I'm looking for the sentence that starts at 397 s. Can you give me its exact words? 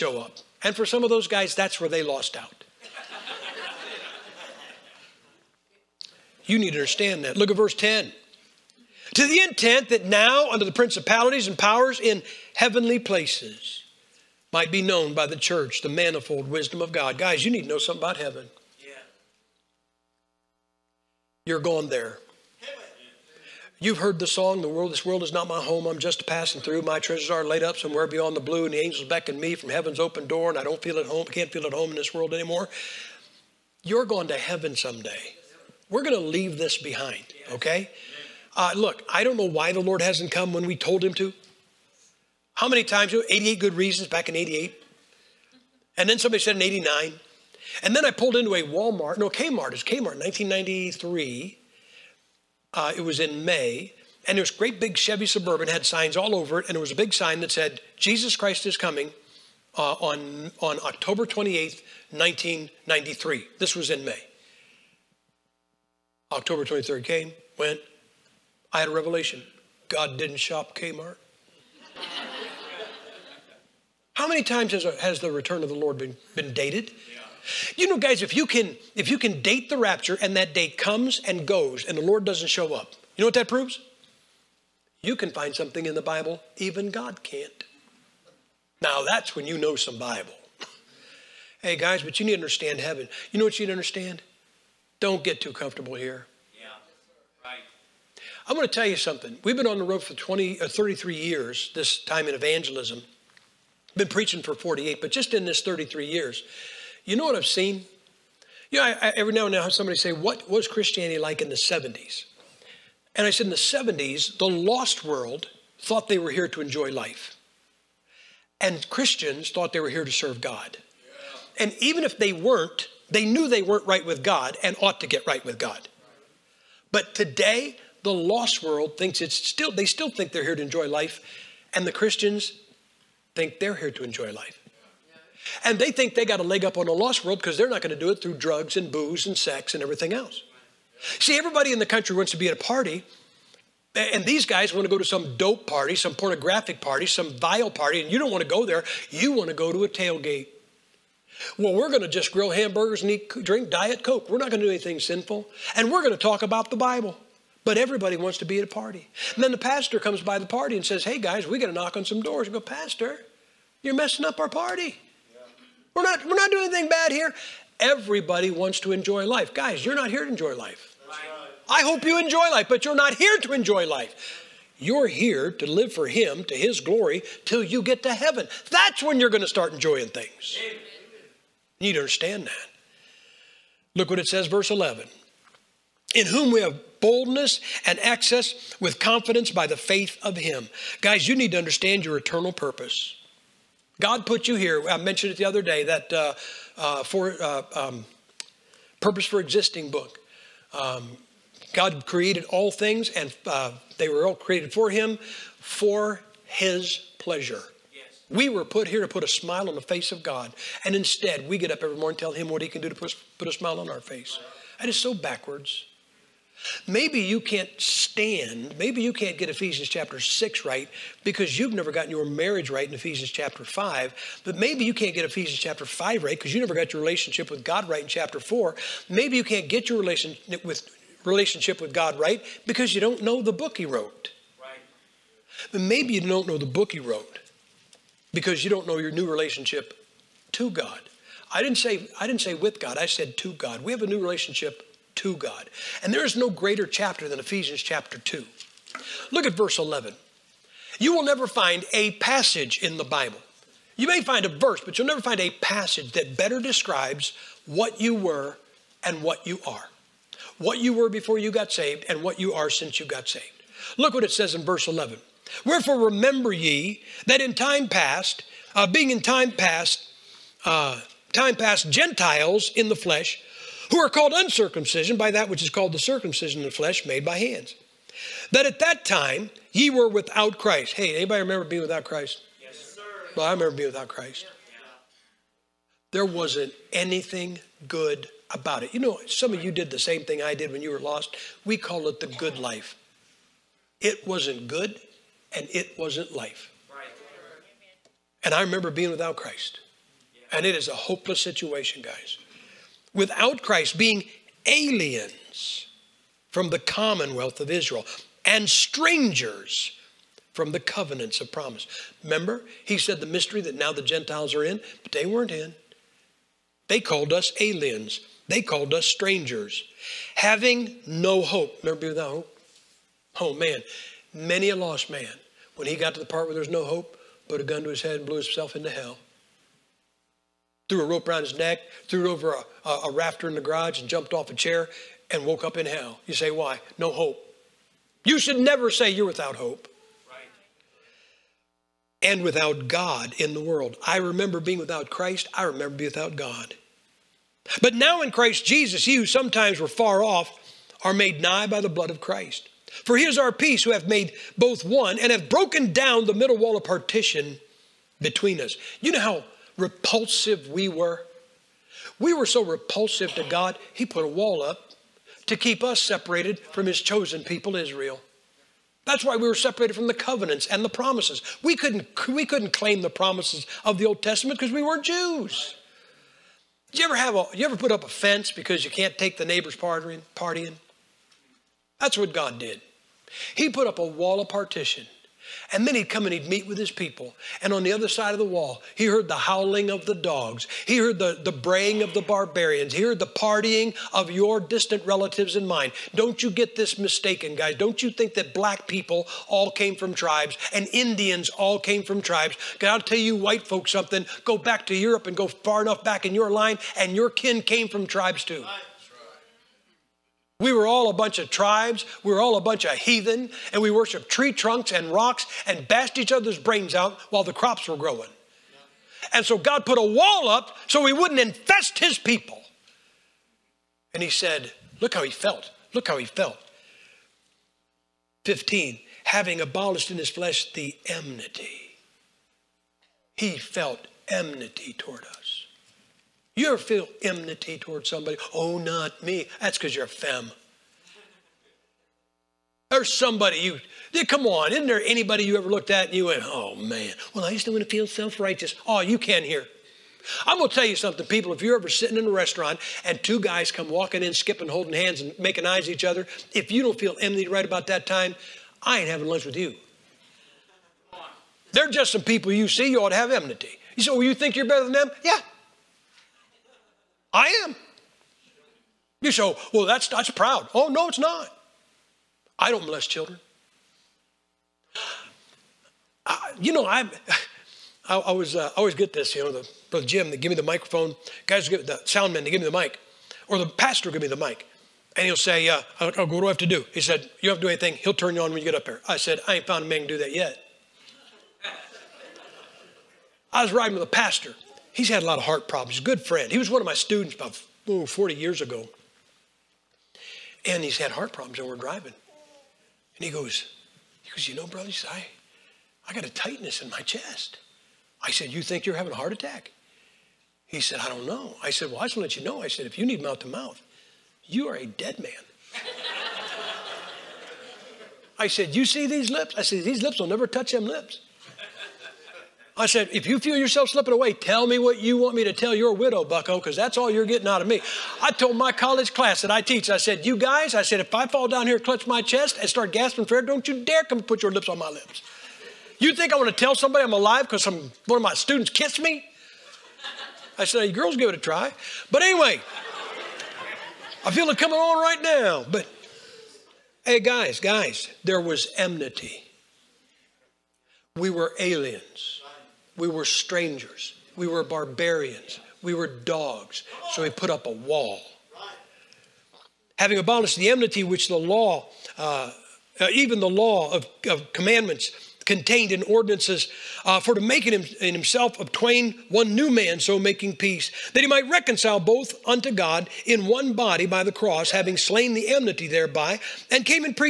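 Don't you think that black people all came from tribes and Indians all came from tribes.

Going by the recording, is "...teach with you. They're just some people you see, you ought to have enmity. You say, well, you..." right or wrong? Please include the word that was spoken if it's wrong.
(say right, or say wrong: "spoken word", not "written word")
wrong: "lunch", not "teach".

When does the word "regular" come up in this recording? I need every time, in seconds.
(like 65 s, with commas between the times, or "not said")
not said.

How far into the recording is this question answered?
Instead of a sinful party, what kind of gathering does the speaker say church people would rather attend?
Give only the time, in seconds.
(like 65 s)
149 s.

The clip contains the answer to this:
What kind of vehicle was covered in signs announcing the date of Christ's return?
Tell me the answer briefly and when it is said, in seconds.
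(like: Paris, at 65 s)
Chevy Suburban, at 54 s.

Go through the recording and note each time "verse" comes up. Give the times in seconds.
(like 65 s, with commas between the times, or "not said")
7 s, 184 s, 249 s, 254 s, 264 s.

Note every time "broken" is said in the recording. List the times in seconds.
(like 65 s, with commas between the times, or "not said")
355 s.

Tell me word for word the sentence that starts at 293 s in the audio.
It wasn't good and it wasn't life.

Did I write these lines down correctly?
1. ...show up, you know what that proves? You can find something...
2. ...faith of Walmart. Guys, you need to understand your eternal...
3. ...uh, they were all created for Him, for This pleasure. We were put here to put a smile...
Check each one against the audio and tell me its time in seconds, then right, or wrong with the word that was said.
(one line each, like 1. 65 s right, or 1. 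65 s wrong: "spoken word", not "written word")
1. 82 s right
2. 189 s wrong: "Him", not "Walmart"
3. 203 s wrong: "His", not "This".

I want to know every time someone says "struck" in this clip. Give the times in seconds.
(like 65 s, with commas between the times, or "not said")
not said.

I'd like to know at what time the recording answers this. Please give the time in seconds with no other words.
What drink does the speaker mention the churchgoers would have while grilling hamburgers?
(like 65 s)
153 s.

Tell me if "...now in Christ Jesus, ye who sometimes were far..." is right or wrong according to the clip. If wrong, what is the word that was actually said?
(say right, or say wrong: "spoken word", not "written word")
right.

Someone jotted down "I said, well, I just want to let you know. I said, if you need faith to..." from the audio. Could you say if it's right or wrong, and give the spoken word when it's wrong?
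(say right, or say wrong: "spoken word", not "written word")
wrong: "mouth", not "faith".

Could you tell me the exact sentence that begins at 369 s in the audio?
That's why we were separated from the covenants and the promises.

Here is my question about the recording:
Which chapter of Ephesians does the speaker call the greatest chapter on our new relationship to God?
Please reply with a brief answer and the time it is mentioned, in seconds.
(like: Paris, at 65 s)
Chapter 2, at 247 s.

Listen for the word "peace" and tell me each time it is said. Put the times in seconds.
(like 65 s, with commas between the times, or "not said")
353 s, 570 s.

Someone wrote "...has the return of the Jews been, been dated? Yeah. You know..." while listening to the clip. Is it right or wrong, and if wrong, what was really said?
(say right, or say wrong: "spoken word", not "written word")
wrong: "Lord", not "Jews".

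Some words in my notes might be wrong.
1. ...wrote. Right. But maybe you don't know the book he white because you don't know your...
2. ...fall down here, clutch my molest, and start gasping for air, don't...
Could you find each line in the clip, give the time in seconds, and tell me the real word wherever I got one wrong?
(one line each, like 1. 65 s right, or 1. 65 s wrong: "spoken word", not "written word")
1. 233 s wrong: "wrote", not "white"
2. 531 s wrong: "chest", not "molest".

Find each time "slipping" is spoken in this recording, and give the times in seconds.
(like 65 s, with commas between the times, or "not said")
523 s.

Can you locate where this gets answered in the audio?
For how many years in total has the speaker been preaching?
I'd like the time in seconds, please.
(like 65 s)
104 s.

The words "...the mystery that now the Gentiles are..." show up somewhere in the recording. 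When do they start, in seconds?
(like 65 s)
313 s.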